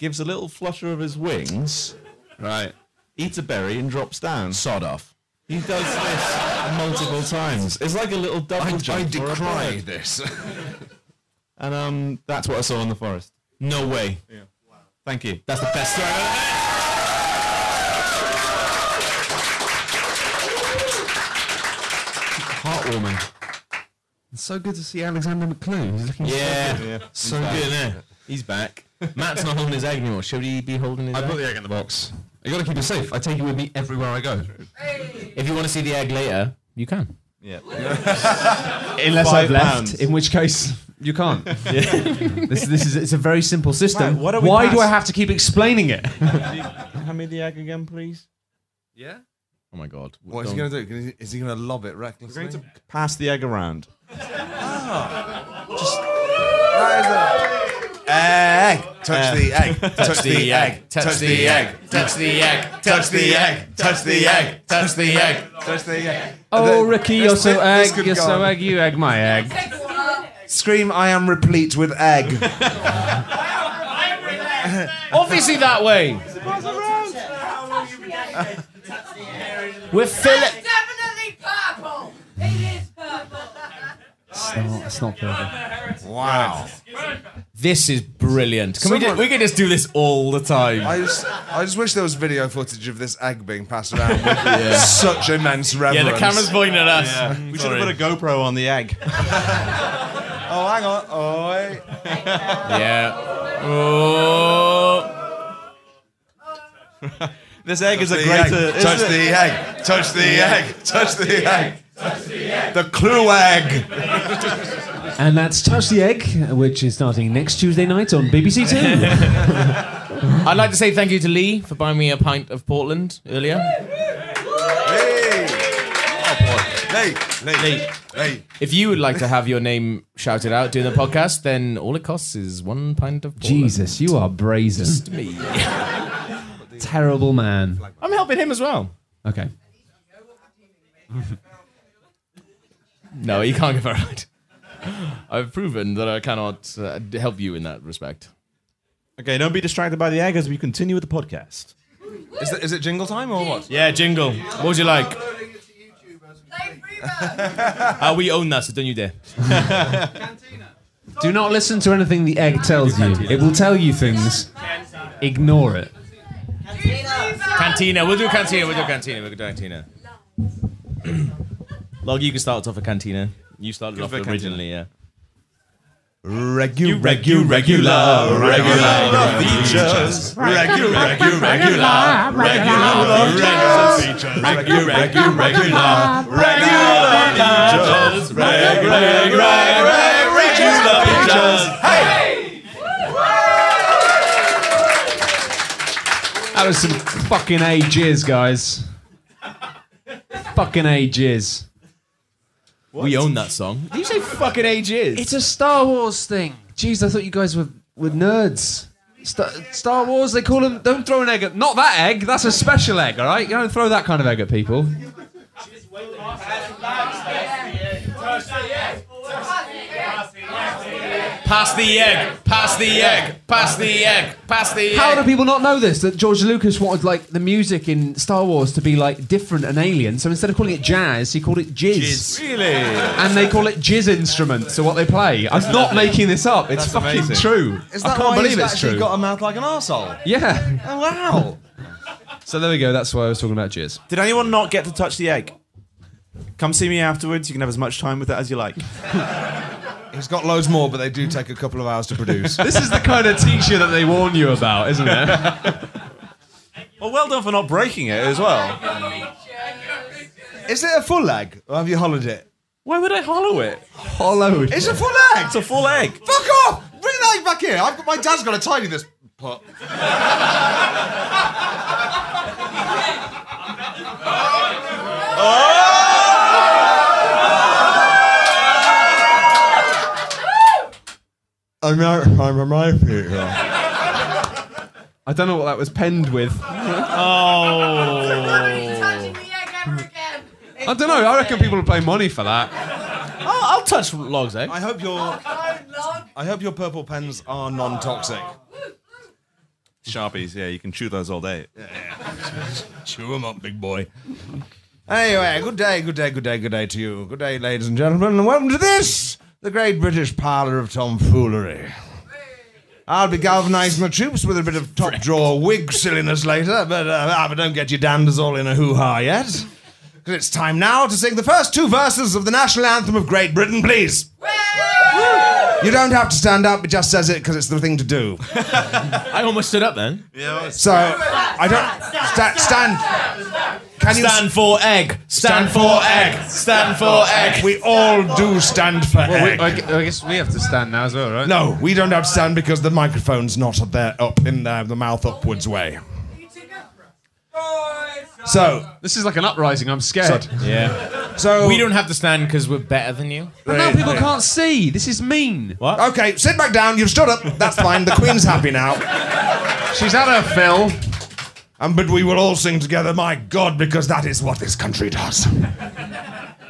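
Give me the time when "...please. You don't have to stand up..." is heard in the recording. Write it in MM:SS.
05:23.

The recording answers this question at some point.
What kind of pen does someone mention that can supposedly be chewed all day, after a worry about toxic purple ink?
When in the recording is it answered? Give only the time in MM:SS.
05:00.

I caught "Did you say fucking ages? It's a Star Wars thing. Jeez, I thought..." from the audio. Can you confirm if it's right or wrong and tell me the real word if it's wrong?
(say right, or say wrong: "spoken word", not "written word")
right.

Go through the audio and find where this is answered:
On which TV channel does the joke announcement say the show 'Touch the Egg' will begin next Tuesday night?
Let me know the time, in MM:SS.
01:58.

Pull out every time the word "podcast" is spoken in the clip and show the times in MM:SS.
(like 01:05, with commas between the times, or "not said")
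02:10, 02:31.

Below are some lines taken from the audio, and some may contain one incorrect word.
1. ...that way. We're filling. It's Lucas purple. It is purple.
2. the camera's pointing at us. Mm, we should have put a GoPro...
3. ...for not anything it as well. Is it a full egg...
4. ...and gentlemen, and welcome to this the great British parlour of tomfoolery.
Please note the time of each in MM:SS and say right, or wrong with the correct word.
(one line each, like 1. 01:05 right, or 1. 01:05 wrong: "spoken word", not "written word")
1. 01:15 wrong: "Definitely", not "Lucas"
2. 01:36 right
3. 04:17 wrong: "breaking", not "anything"
4. 05:07 right.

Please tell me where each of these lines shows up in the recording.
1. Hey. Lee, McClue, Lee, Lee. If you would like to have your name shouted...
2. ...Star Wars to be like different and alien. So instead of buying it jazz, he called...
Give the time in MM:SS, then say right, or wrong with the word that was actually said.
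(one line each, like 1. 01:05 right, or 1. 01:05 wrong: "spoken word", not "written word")
1. 02:03 wrong: "Lee", not "McClue"
2. 03:48 wrong: "calling", not "buying".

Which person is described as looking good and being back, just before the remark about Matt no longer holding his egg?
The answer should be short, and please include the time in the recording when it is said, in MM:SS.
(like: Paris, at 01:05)
Alexander McClue, at 00:25.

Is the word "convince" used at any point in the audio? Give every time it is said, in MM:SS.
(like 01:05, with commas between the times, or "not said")
not said.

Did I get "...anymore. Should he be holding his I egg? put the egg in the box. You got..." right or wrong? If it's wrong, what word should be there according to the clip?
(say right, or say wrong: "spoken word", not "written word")
right.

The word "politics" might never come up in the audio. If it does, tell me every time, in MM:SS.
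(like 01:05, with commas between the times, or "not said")
not said.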